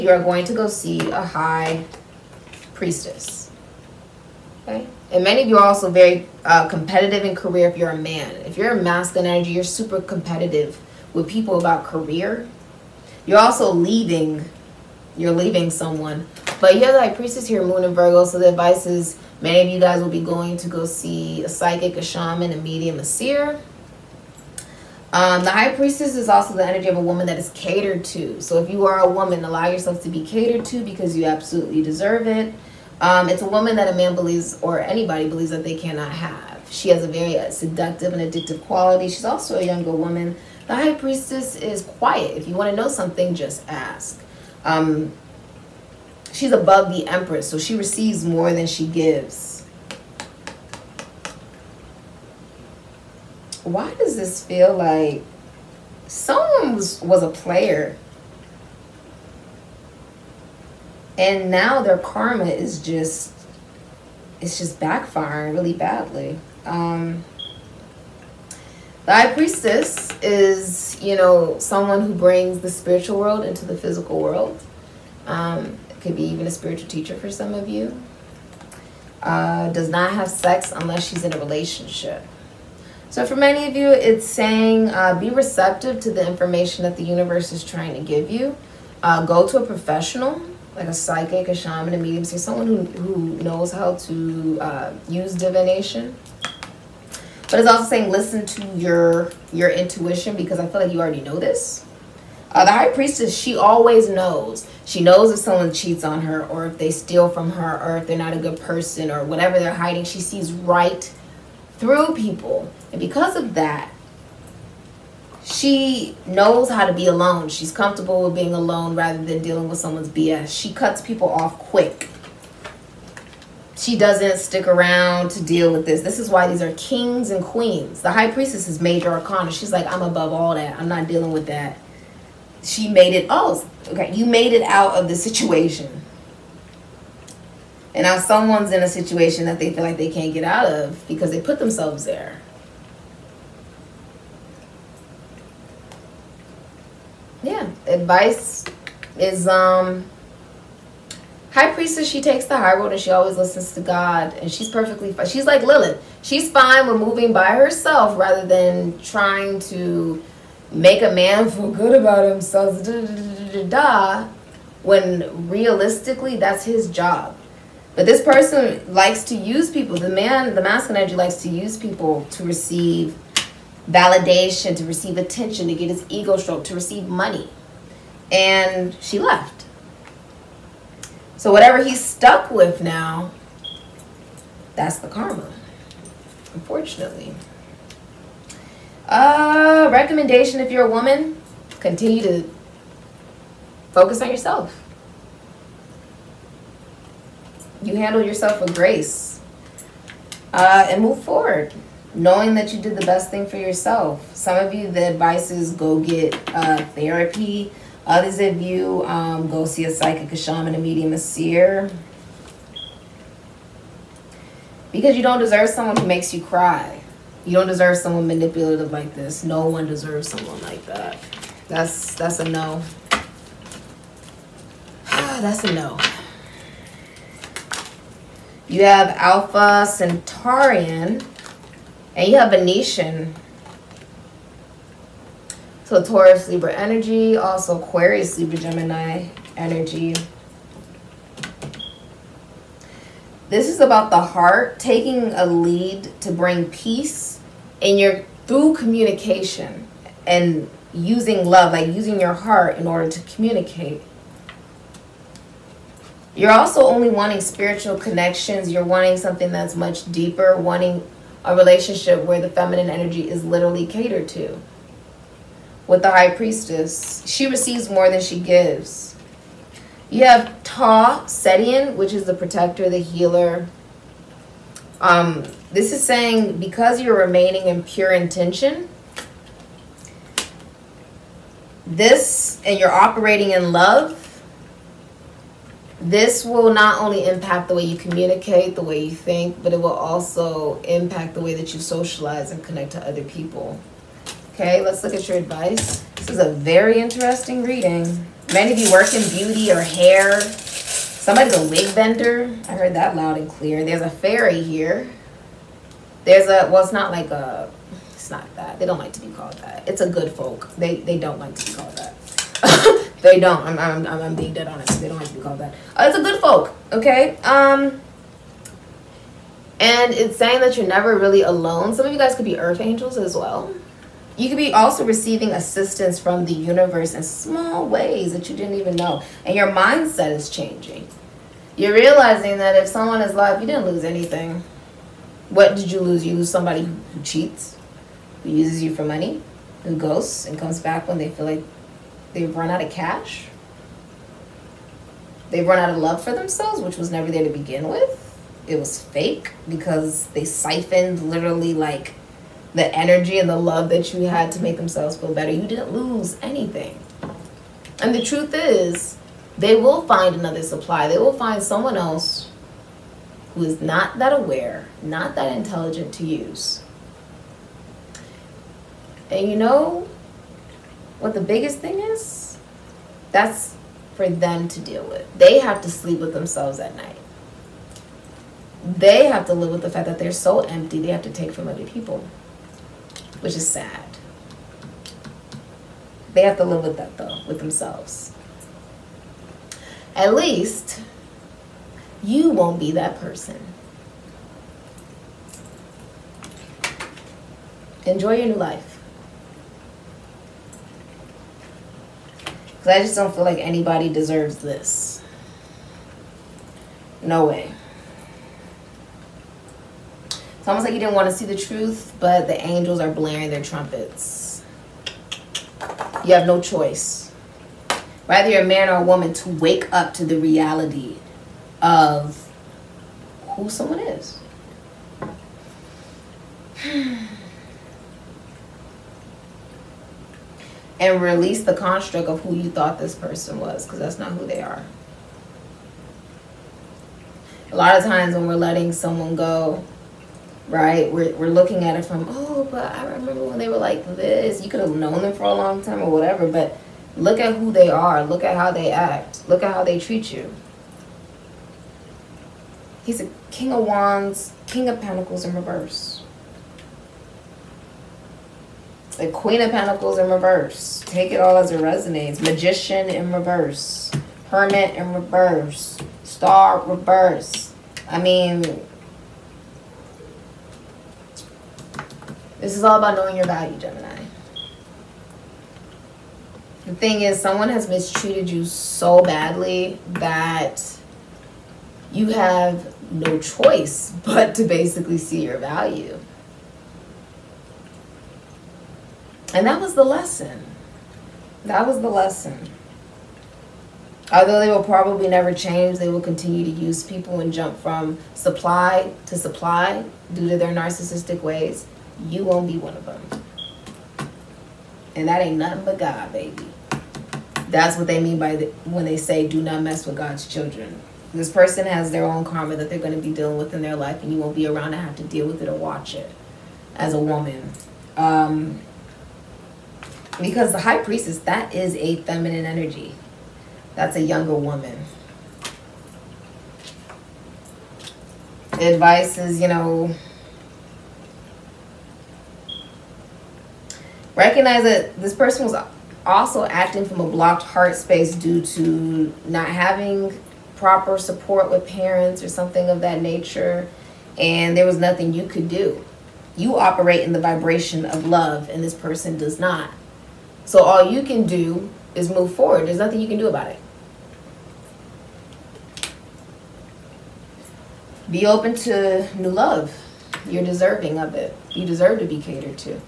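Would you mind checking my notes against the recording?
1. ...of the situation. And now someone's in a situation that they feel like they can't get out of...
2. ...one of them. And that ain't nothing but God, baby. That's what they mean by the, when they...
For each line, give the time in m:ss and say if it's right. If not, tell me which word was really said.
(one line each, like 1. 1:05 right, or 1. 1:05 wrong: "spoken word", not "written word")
1. 2:14 right
2. 8:22 right.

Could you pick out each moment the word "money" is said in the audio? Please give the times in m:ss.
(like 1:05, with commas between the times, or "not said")
2:57, 5:39.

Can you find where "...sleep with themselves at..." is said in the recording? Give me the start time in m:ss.
6:15.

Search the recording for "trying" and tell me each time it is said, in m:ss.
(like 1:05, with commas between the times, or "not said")
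1:27, 2:39.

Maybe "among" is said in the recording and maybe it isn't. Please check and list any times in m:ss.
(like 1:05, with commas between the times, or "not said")
not said.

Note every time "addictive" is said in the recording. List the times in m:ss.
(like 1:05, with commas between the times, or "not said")
0:38.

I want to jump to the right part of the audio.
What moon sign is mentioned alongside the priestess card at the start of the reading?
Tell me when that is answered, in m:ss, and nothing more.
0:17.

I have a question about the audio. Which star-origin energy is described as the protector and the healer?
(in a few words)
Ta Setian.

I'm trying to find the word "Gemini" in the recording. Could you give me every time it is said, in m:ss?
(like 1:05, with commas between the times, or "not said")
3:58, 7:53.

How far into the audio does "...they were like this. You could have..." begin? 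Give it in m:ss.
7:23.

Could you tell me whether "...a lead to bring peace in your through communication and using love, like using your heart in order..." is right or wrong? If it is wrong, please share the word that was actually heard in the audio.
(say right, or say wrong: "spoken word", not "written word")
right.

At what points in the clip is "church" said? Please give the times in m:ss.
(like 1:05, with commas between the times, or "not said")
not said.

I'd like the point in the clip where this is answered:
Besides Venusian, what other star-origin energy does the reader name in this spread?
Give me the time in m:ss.
3:48.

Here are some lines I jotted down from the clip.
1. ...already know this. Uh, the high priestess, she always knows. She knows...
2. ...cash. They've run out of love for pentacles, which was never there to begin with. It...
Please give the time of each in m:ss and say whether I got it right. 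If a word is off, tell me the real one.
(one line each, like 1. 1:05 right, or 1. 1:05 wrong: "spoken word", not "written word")
1. 1:40 right
2. 5:42 wrong: "themselves", not "pentacles".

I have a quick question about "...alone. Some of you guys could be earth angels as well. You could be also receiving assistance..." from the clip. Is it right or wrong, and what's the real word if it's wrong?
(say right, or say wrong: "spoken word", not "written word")
right.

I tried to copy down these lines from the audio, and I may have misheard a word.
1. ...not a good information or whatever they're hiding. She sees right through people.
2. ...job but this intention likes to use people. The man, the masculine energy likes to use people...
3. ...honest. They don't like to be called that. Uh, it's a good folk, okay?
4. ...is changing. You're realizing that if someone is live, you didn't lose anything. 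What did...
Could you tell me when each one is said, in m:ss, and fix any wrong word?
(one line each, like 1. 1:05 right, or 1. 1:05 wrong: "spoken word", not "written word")
1. 1:48 wrong: "person", not "information"
2. 2:46 wrong: "person", not "intention"
3. 5:14 right
4. 5:30 right.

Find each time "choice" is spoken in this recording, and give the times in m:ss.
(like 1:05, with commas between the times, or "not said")
6:56, 8:03.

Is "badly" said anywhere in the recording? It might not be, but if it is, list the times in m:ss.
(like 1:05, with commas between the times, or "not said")
1:05, 7:59.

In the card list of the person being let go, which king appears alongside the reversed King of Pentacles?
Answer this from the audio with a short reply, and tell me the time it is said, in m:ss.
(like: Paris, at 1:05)
King of Wands, at 7:33.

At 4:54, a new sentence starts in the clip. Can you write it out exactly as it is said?
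Okay, let's look at your advice.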